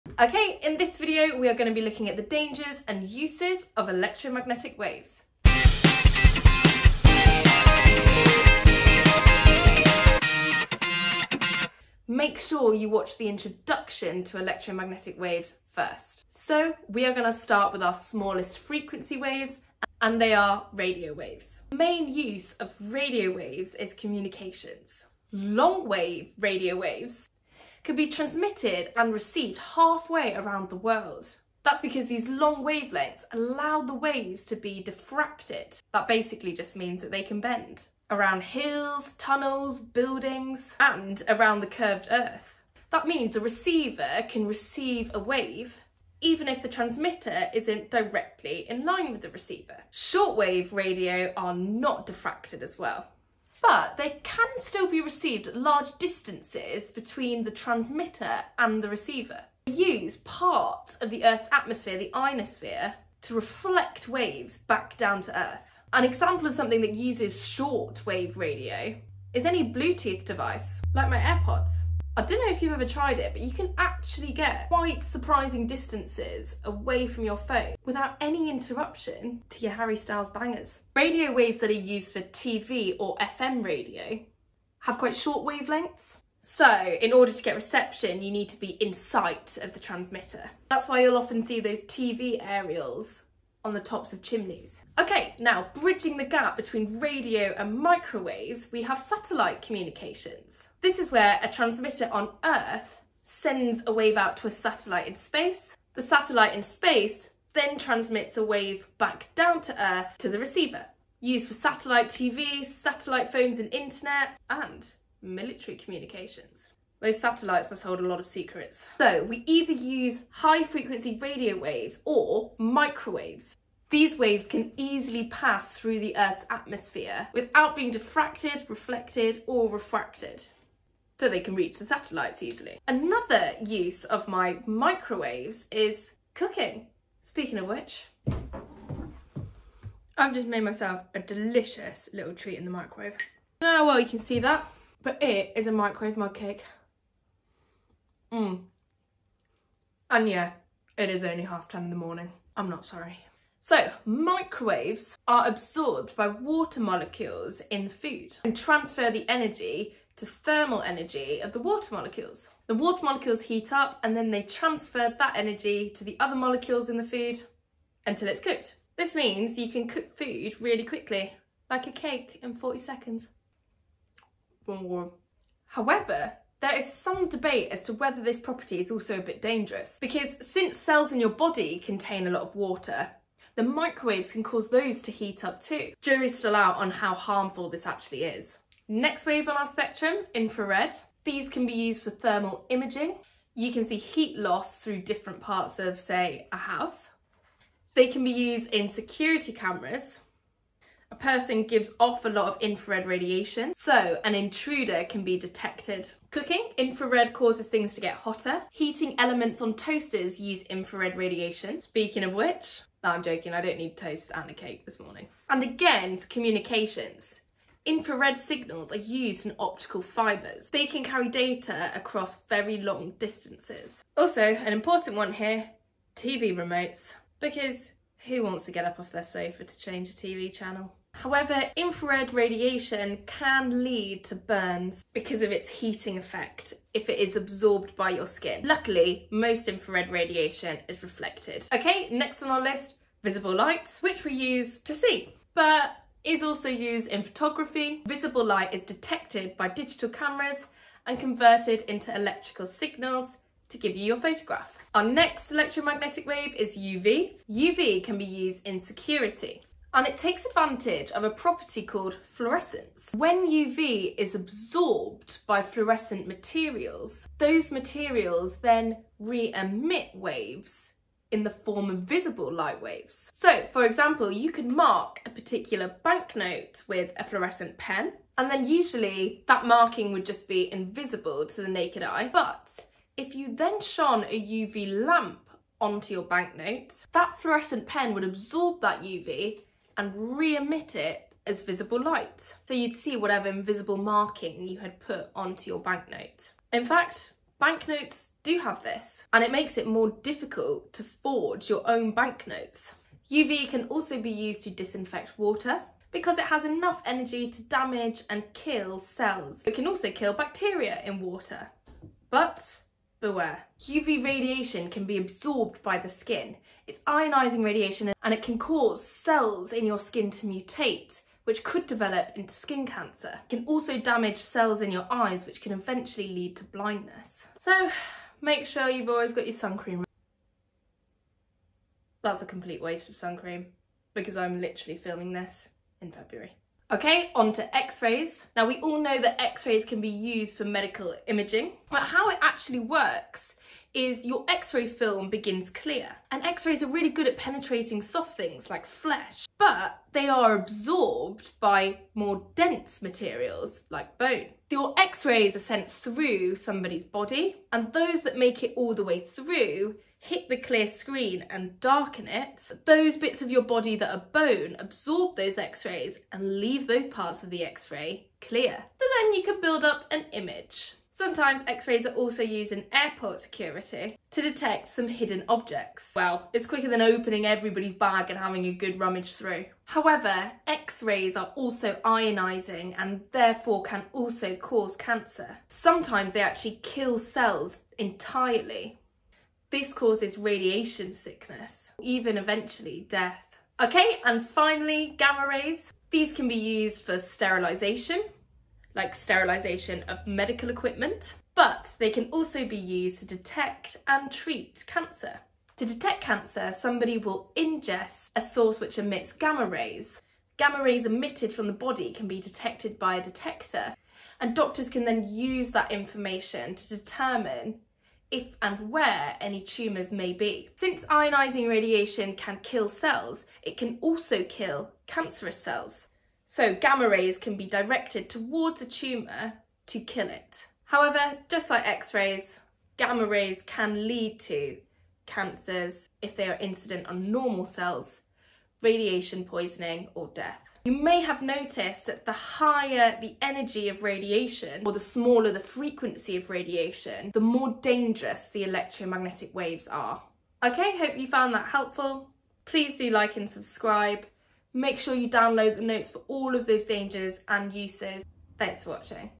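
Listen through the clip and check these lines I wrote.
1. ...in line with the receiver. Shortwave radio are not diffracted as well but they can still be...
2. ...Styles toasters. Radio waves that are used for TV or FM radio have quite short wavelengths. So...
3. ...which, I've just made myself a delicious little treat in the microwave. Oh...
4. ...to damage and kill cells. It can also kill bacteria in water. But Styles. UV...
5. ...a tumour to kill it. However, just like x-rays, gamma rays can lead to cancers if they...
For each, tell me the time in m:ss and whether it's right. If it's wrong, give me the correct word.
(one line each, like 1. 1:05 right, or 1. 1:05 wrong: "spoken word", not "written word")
1. 0:48 right
2. 1:19 wrong: "bangers", not "toasters"
3. 2:17 right
4. 5:07 wrong: "Beware", not "Styles"
5. 7:08 right.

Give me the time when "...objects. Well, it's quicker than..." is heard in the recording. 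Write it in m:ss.
6:15.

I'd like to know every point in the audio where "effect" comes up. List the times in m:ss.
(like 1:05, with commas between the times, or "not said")
3:56.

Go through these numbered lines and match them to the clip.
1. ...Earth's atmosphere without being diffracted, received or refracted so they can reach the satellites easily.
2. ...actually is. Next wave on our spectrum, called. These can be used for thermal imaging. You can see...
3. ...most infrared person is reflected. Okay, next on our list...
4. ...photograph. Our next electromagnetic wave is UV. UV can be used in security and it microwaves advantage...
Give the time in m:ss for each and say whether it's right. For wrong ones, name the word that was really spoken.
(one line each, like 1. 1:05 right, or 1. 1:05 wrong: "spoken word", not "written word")
1. 2:06 wrong: "reflected", not "received"
2. 3:07 wrong: "infrared", not "called"
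3. 3:59 wrong: "radiation", not "person"
4. 4:14 wrong: "takes", not "microwaves".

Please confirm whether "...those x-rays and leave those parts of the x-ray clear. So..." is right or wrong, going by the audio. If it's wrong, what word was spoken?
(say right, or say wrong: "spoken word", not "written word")
right.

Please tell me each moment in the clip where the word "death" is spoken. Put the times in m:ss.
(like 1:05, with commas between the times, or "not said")
6:33, 7:20.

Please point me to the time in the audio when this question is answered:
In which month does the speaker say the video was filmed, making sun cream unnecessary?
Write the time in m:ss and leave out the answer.
5:36.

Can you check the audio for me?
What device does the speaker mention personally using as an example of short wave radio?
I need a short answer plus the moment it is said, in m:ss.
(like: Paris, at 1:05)
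AirPods, at 1:11.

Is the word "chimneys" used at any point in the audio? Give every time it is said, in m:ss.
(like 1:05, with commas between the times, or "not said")
1:34.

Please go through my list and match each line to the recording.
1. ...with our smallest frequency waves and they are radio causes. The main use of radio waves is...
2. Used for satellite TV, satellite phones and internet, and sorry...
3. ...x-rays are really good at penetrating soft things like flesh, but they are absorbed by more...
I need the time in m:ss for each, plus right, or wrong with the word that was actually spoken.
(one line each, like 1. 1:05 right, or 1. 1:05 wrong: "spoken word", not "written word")
1. 0:17 wrong: "waves", not "causes"
2. 1:51 wrong: "military", not "sorry"
3. 5:46 right.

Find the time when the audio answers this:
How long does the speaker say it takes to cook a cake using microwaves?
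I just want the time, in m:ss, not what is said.
2:52.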